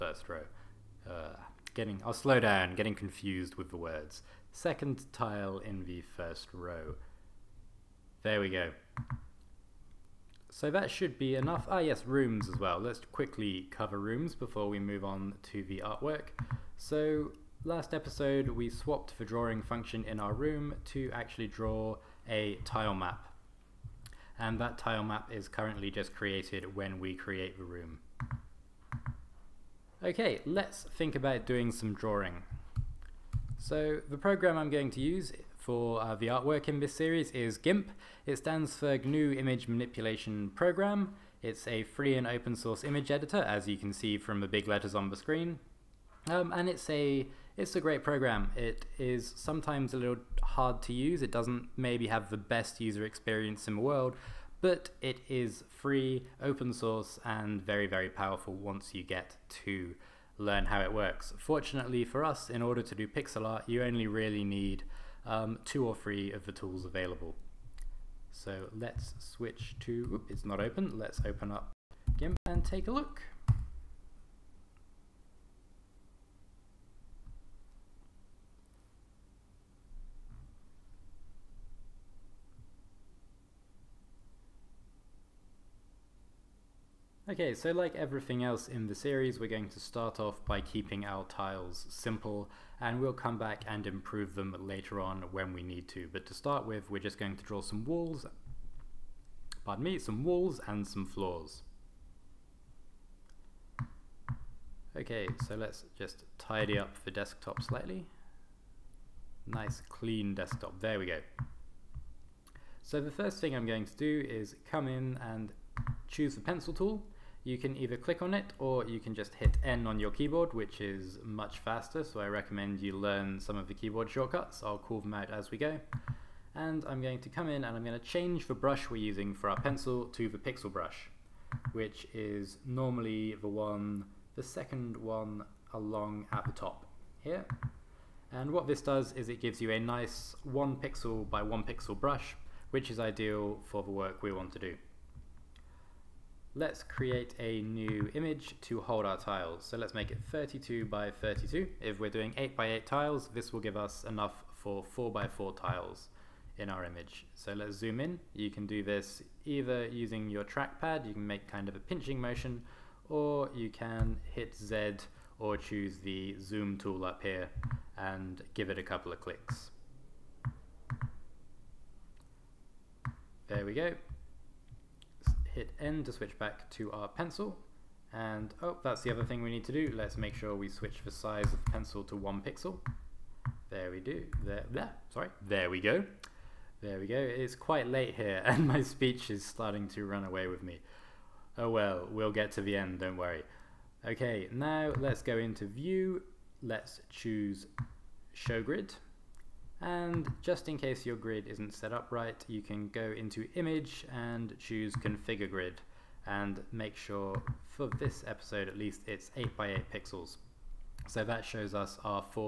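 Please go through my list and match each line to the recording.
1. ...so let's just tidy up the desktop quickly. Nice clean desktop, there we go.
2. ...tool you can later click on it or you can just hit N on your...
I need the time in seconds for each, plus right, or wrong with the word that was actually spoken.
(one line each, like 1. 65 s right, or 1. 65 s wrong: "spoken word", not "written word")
1. 105 s wrong: "slightly", not "quickly"
2. 116 s wrong: "either", not "later".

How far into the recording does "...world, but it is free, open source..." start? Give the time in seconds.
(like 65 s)
53 s.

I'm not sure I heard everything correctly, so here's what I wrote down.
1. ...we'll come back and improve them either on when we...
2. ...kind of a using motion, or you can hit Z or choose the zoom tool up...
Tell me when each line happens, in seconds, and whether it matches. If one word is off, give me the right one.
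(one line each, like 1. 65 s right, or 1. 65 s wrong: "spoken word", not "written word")
1. 93 s wrong: "later", not "either"
2. 161 s wrong: "pinching", not "using".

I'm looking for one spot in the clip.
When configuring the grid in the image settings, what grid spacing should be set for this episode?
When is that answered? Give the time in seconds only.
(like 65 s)
209 s.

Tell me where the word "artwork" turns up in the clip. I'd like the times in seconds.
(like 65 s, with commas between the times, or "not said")
15 s, 36 s.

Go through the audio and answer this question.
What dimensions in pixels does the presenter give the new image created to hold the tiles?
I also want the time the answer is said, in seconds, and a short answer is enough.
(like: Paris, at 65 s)
32 by 32, at 150 s.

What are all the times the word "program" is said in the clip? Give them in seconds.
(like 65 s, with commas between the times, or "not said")
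34 s, 40 s, 48 s.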